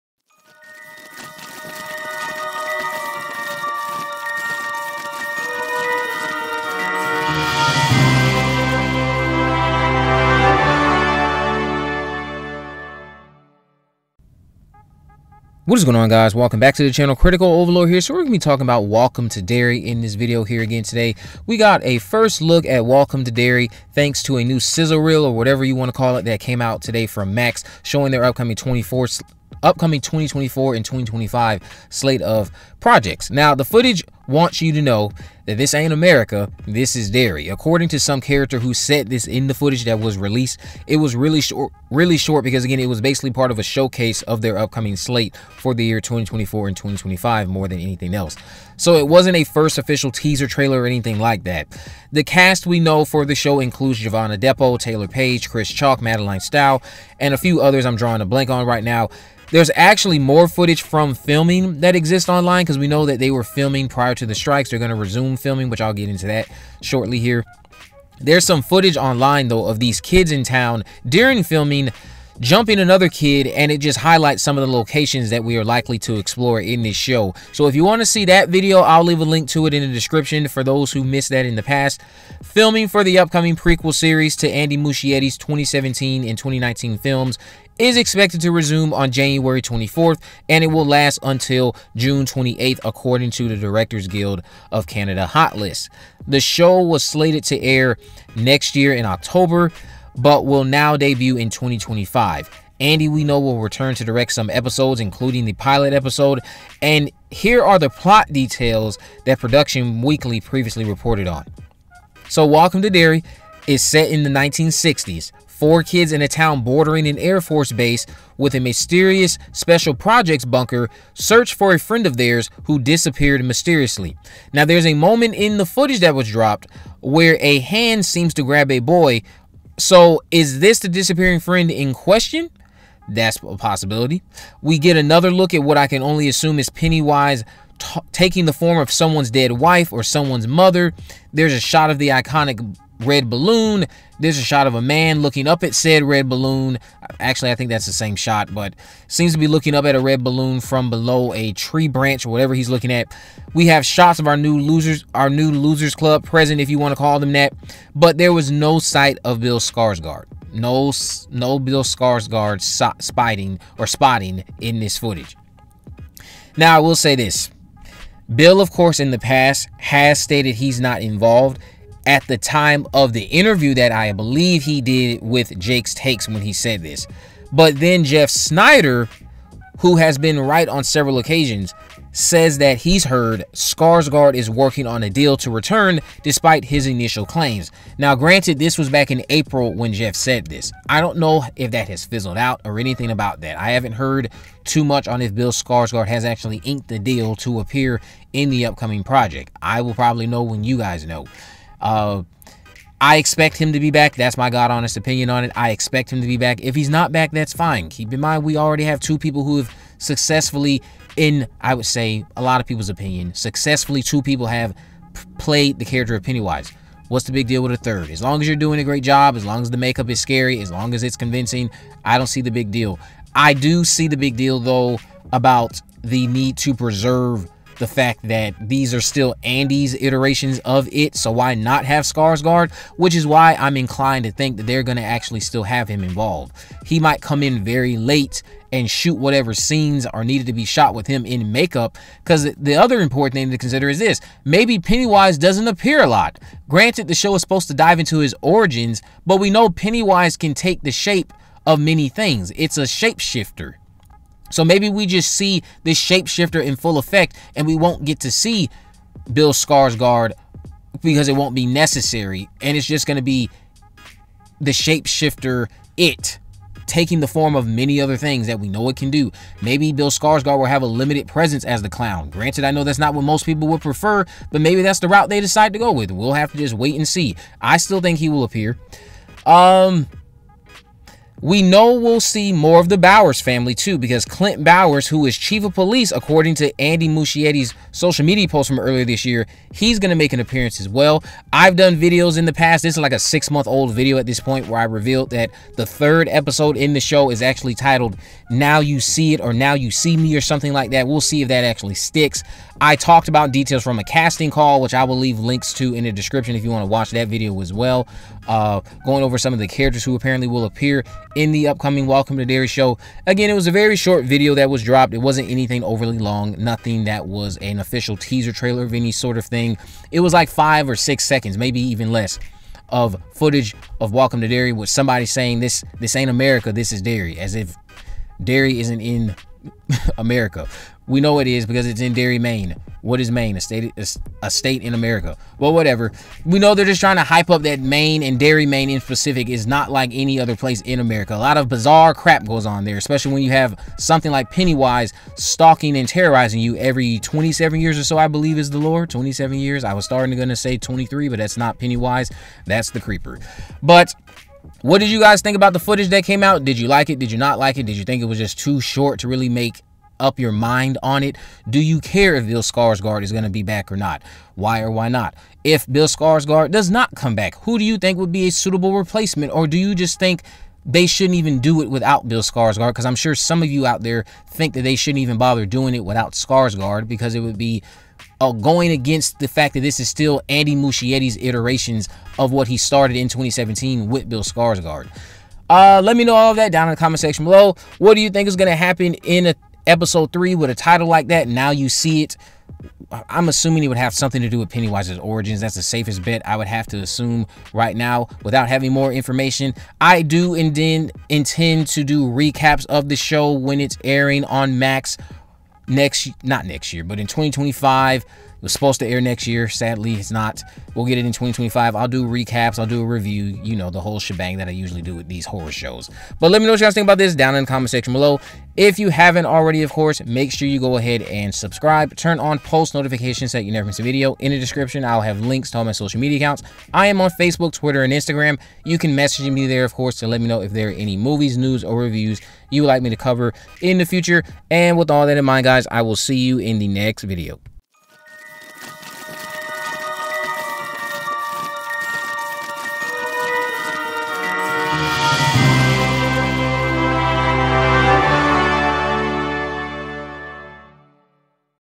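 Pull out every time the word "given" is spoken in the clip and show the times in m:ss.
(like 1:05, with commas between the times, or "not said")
not said.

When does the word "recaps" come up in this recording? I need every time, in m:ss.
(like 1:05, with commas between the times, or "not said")
6:42, 6:52.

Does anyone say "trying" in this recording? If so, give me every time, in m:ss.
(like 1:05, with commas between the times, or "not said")
5:37.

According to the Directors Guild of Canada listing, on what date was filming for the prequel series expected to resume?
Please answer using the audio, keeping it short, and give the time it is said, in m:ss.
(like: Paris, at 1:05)
January 24, at 1:29.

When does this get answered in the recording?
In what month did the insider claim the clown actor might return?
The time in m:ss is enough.
3:09.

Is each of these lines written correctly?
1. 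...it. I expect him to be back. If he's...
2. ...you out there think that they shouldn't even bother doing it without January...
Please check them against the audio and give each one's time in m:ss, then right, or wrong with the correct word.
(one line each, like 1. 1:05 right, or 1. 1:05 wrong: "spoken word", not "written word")
1. 3:25 right
2. 6:13 wrong: "Skarsgård", not "January".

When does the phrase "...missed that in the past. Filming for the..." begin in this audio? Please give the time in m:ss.
1:21.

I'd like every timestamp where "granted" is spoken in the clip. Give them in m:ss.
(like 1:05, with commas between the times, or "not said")
3:08, 4:06, 4:32.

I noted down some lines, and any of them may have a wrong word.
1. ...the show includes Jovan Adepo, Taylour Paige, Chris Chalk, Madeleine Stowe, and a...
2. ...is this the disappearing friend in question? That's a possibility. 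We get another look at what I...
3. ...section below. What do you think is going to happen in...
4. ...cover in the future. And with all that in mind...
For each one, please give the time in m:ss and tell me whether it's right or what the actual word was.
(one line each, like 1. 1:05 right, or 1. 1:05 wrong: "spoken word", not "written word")
1. 0:53 right
2. 2:10 right
3. 6:27 right
4. 7:13 right.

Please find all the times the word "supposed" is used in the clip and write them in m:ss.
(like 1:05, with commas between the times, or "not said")
4:07, 6:48.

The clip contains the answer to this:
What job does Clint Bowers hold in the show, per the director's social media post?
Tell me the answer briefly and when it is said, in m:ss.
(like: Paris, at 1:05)
chief of police, at 4:45.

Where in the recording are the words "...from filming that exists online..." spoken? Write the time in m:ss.
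1:00.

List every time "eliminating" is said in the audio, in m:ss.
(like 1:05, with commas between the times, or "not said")
not said.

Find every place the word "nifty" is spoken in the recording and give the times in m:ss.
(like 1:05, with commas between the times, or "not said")
not said.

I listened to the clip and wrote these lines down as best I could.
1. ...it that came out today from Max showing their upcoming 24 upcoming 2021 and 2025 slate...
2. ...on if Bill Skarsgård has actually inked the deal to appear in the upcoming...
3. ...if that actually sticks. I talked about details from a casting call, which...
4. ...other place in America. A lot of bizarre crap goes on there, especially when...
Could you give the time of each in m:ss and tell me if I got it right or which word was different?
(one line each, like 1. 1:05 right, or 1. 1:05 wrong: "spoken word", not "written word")
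1. 0:26 wrong: "2024", not "2021"
2. 3:15 right
3. 5:01 right
4. 5:40 right.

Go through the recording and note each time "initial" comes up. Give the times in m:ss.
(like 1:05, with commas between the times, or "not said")
3:06.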